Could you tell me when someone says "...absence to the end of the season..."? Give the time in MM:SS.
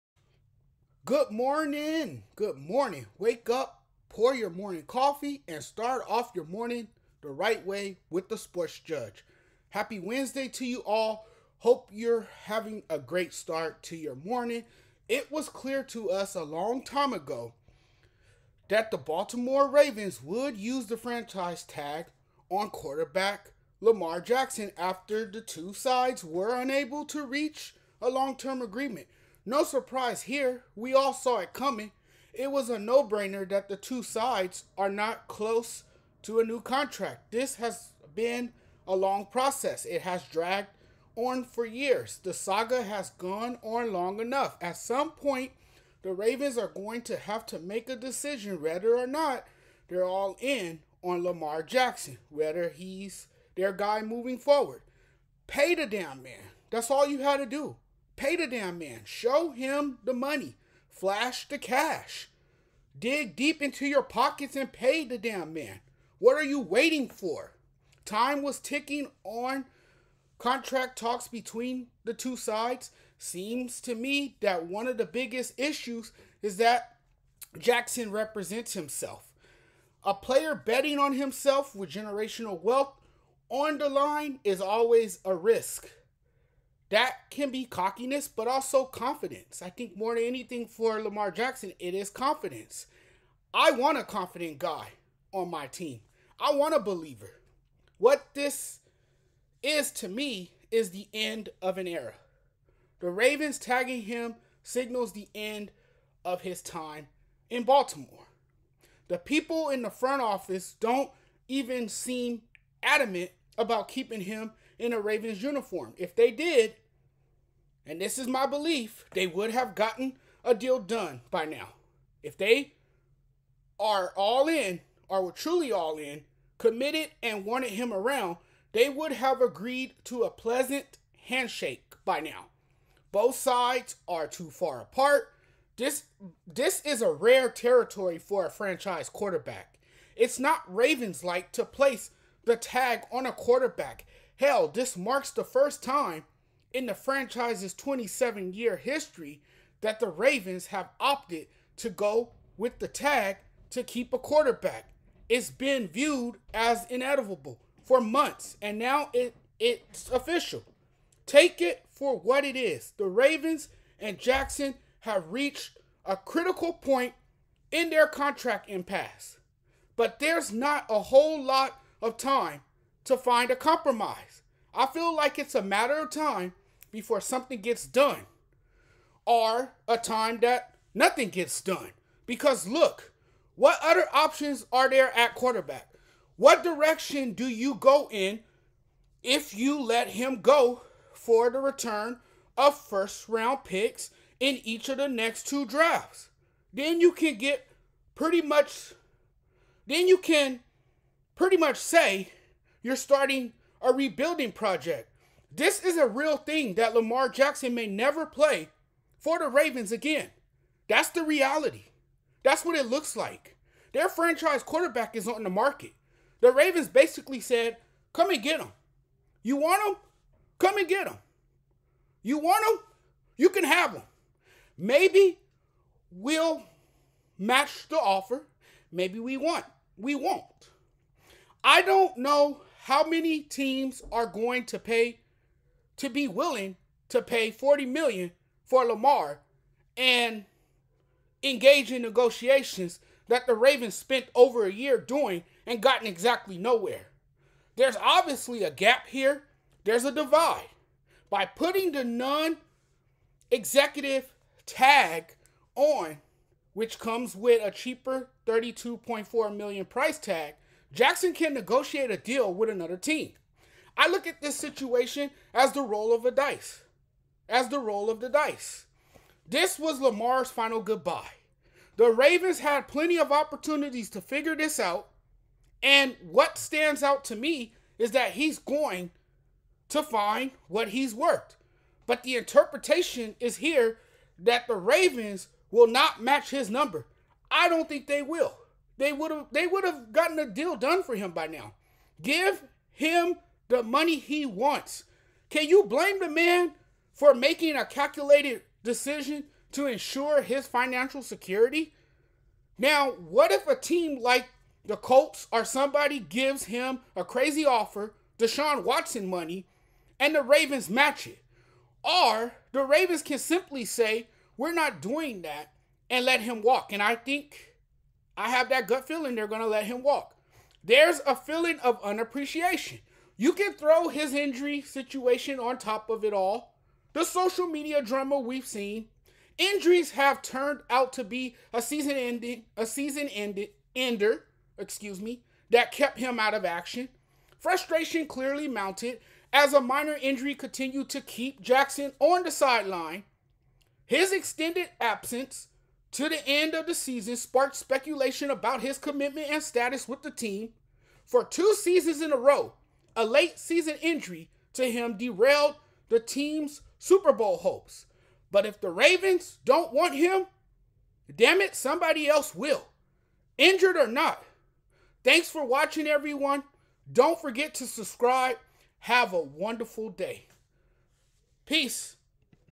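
05:44.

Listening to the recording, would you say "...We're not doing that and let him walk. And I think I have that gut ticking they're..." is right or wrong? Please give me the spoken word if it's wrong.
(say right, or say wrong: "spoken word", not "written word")
wrong: "feeling", not "ticking".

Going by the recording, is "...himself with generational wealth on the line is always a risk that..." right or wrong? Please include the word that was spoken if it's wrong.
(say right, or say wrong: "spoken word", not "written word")
right.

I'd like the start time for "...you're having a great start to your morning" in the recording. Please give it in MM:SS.
00:11.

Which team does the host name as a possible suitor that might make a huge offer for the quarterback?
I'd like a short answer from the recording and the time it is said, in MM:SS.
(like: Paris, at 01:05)
Colts, at 05:04.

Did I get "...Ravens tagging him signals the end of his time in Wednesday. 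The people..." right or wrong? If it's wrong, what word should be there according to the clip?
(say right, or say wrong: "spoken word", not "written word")
wrong: "Baltimore", not "Wednesday".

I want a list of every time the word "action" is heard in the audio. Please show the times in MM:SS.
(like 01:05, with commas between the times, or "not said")
05:36.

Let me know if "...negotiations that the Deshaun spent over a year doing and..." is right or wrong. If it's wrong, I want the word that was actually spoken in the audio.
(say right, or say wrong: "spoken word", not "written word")
wrong: "Ravens", not "Deshaun".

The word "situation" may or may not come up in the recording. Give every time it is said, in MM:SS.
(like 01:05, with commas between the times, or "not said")
04:24, 05:24.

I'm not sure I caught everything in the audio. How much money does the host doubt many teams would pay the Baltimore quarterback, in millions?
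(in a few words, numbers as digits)
40 million.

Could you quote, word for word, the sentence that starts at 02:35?
It's been viewed as inedible for months, and now it, it's official.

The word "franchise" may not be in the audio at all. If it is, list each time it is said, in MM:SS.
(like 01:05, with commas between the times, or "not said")
00:20, 02:18, 02:26, 03:34.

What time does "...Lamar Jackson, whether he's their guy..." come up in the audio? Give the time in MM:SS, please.
00:51.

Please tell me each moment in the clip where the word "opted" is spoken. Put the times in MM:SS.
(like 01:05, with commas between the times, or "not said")
02:30.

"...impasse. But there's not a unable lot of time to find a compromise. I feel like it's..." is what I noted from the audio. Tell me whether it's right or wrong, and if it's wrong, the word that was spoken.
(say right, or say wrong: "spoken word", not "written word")
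wrong: "whole", not "unable".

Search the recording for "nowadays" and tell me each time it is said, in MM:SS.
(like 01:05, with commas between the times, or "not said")
not said.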